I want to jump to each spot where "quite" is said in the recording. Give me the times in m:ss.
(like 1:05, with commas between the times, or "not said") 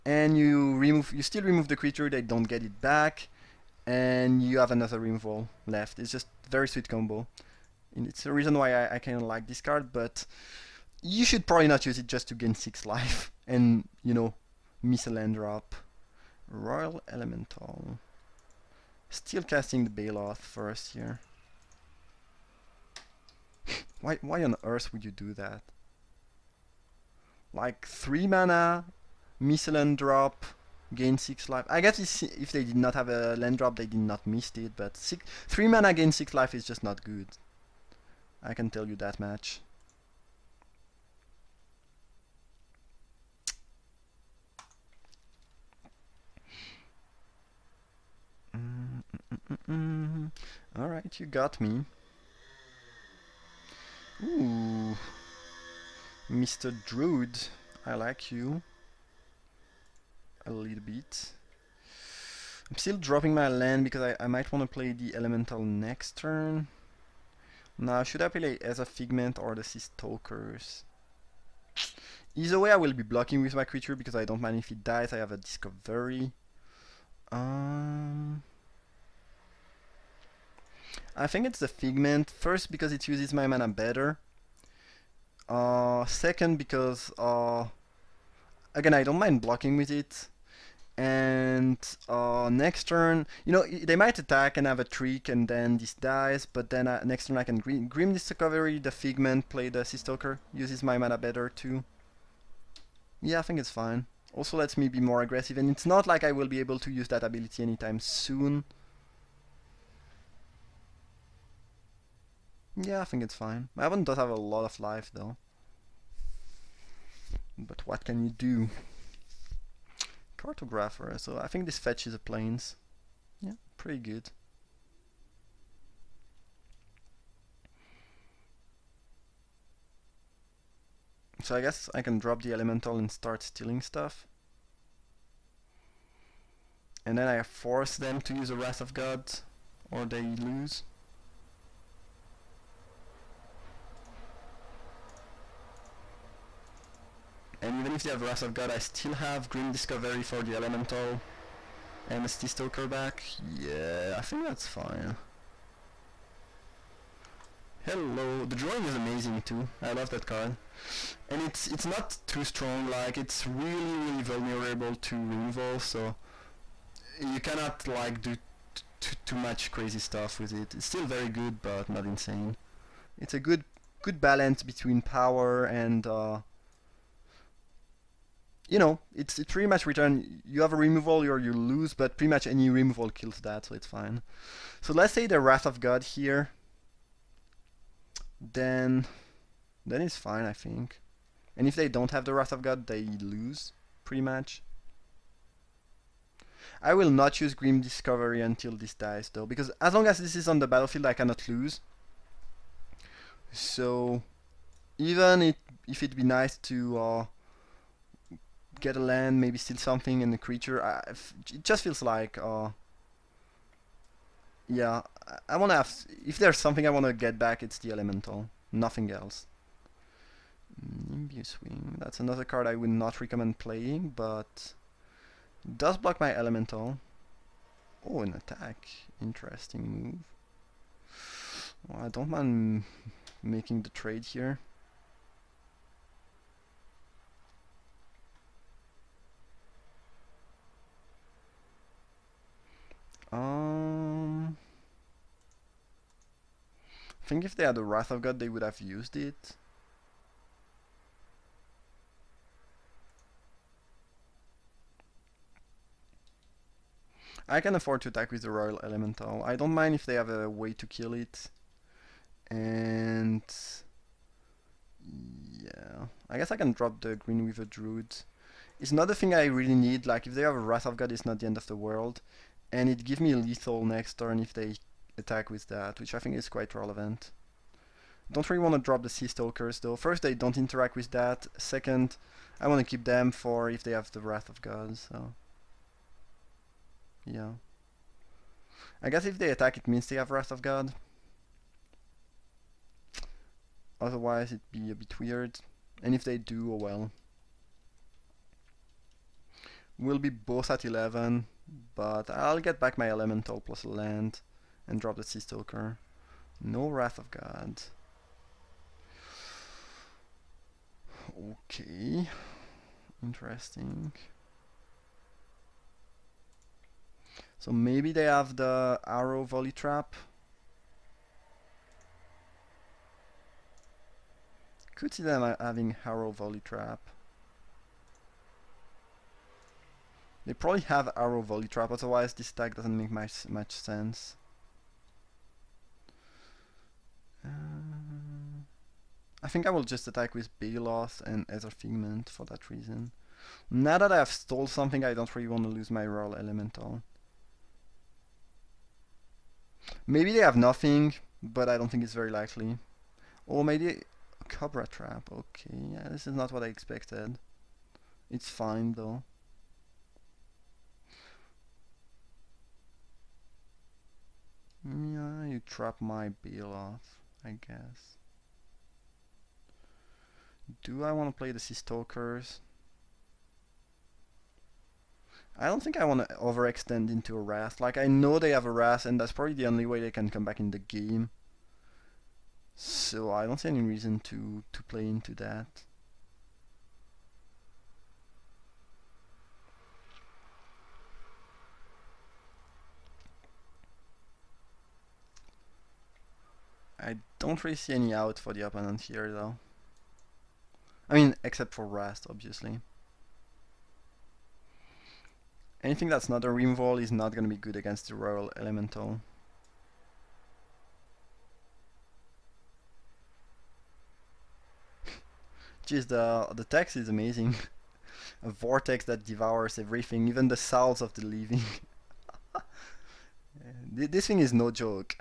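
4:36.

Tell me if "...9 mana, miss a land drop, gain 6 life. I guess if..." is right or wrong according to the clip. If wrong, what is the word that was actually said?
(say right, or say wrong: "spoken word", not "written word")
wrong: "3", not "9".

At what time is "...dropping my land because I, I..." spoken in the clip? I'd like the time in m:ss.
1:02.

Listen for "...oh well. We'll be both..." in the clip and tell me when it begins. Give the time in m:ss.
4:56.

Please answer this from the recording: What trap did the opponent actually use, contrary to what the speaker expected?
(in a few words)
Cobra Trap.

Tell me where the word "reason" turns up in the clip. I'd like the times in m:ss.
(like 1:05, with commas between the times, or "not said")
0:08, 5:42, 6:23.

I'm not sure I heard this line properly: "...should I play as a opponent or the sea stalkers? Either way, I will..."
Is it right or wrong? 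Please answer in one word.
wrong.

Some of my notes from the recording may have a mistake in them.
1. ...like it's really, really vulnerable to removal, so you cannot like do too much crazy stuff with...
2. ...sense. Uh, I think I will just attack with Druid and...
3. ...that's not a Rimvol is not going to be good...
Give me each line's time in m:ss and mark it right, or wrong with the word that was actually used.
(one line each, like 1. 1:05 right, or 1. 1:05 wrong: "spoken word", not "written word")
1. 2:42 right
2. 5:33 wrong: "Loss", not "Druid"
3. 6:46 right.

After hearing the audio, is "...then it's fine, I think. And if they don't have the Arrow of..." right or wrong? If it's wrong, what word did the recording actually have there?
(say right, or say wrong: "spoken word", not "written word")
wrong: "Wrath", not "Arrow".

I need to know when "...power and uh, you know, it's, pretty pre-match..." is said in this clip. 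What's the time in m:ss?
2:55.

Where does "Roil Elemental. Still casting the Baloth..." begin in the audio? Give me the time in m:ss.
0:16.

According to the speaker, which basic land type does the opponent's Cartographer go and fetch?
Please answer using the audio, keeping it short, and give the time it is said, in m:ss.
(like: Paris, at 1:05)
Plains, at 2:02.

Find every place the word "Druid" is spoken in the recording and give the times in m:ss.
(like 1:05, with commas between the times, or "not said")
0:56, 4:27.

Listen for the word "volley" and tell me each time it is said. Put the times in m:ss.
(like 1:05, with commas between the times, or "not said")
5:19, 5:26, 5:31.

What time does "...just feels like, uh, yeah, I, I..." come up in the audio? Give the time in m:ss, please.
3:31.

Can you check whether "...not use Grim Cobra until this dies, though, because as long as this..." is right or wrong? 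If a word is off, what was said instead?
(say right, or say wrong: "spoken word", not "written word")
wrong: "Discovery", not "Cobra".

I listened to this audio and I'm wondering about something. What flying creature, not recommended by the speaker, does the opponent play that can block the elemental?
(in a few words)
Nimbus Wing.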